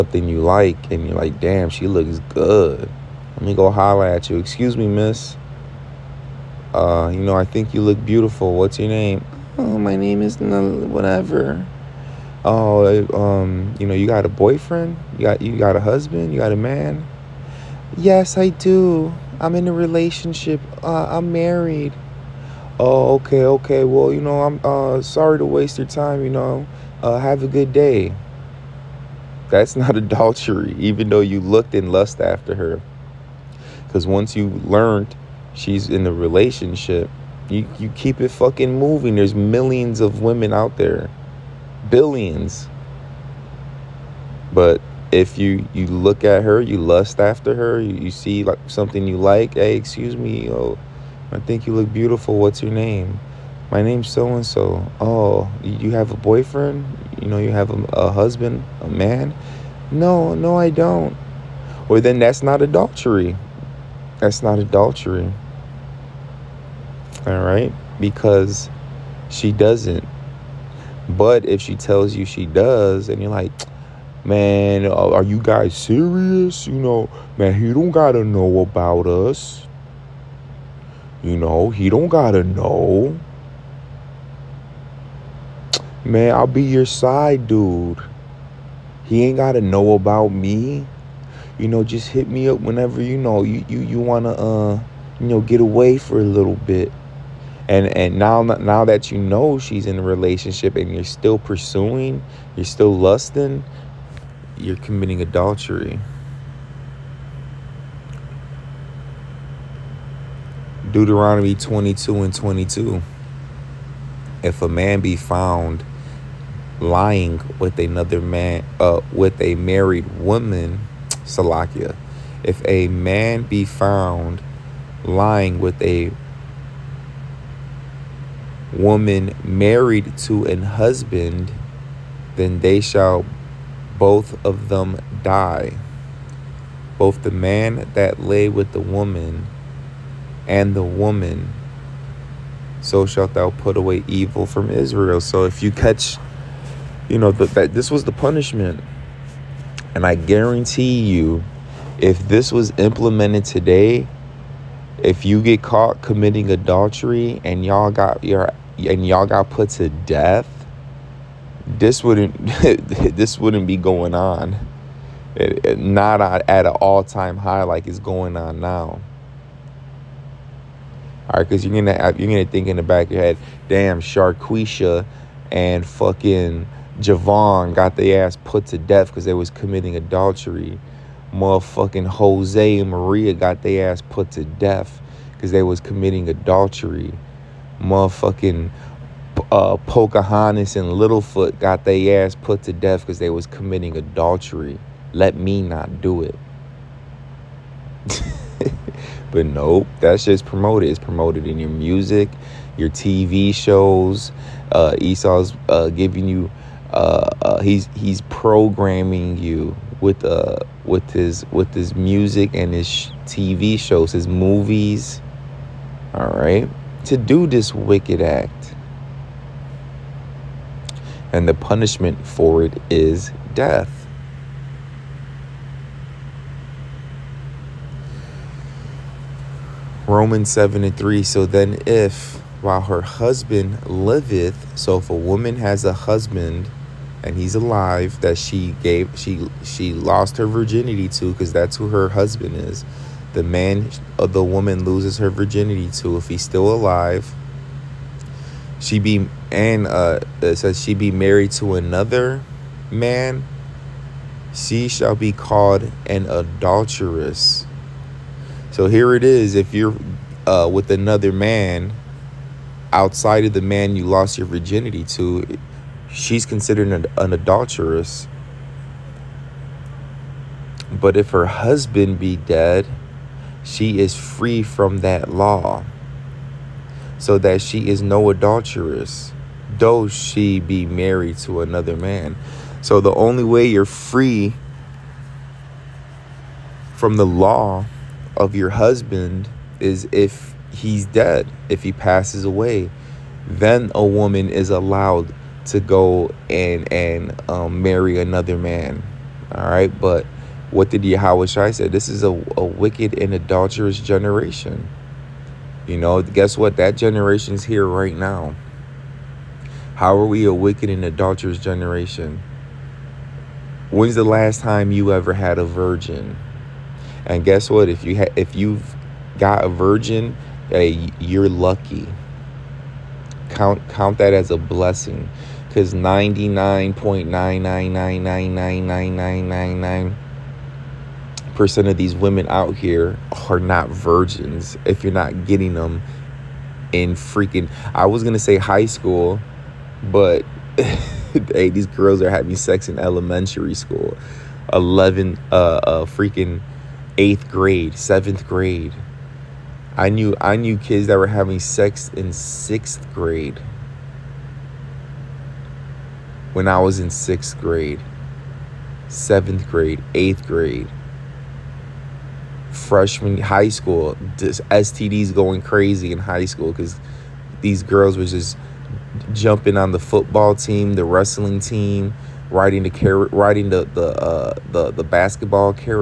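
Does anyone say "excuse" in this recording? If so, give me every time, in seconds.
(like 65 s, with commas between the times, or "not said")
4 s, 49 s.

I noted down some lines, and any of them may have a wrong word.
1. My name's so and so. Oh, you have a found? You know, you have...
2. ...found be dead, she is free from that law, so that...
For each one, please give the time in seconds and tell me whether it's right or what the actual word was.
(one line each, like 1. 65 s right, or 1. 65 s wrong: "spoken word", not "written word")
1. 53 s wrong: "boyfriend", not "found"
2. 271 s wrong: "husband", not "found".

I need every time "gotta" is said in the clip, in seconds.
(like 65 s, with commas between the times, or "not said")
77 s, 82 s, 89 s.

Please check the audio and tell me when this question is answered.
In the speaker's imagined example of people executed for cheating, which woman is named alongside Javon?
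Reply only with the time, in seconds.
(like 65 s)
174 s.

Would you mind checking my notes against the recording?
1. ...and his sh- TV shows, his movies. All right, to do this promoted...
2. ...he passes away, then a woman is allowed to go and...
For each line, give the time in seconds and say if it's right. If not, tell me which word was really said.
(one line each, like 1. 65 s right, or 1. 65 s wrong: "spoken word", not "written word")
1. 212 s wrong: "wicked", not "promoted"
2. 291 s right.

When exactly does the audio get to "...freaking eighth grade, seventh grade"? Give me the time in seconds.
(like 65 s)
346 s.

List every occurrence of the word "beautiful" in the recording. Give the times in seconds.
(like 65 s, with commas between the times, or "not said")
8 s, 51 s.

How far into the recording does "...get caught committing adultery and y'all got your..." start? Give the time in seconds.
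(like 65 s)
155 s.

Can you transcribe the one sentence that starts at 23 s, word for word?
Well, you know, I'm uh, sorry to waste your time, you know.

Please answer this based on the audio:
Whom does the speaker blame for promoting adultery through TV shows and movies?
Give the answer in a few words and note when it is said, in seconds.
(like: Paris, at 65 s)
Esau, at 205 s.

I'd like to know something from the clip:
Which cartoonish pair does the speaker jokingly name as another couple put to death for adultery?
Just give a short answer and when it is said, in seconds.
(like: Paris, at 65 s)
Pocahontas and Littlefoot, at 189 s.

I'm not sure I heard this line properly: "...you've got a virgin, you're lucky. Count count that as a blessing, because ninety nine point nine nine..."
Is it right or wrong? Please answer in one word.
right.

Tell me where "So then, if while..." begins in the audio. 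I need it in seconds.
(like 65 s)
231 s.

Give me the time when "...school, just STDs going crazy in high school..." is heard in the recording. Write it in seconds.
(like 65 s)
363 s.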